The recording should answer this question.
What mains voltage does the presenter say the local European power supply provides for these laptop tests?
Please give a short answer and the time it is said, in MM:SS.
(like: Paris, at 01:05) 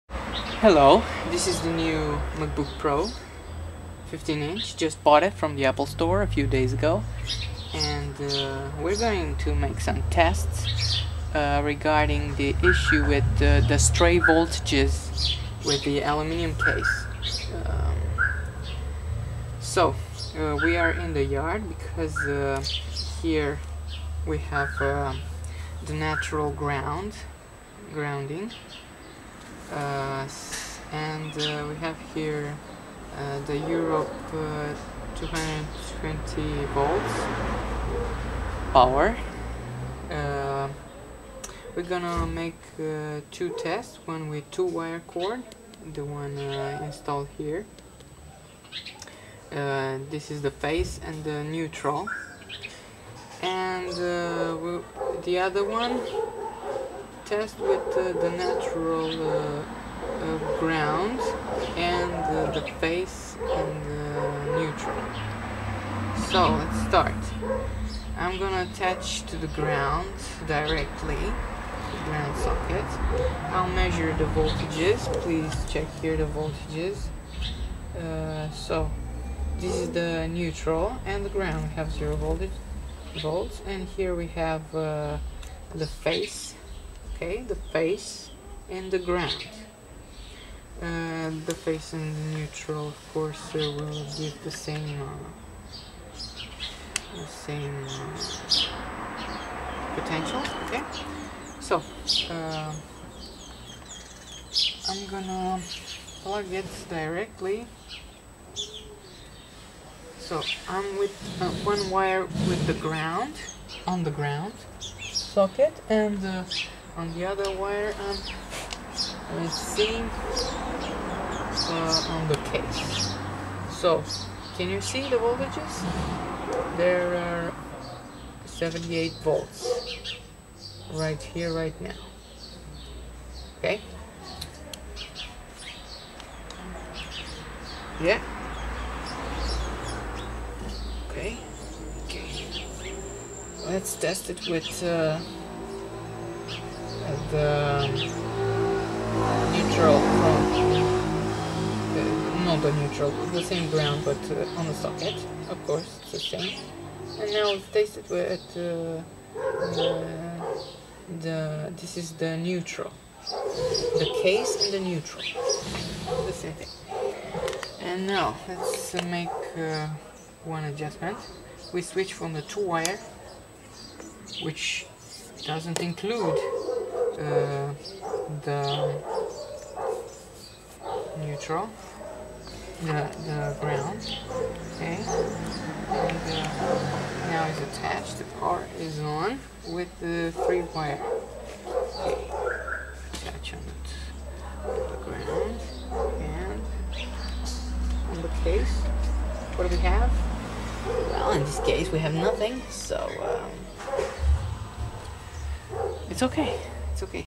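220 volts, at 00:35.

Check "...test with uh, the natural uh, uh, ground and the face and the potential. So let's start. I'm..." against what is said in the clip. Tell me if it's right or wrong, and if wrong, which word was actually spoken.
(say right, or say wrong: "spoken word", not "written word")
wrong: "neutral", not "potential".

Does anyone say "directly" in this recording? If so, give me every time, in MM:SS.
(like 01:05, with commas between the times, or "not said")
01:10, 01:46.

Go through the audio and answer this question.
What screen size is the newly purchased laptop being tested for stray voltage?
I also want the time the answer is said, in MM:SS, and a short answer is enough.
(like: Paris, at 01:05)
15 inch, at 00:04.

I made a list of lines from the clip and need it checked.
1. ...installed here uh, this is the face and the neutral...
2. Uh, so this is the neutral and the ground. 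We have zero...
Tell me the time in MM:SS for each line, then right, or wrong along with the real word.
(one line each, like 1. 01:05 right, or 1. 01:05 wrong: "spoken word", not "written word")
1. 00:46 right
2. 01:17 right.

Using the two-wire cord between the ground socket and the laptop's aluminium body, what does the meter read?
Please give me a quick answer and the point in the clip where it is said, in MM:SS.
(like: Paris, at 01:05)
78 volts, at 02:08.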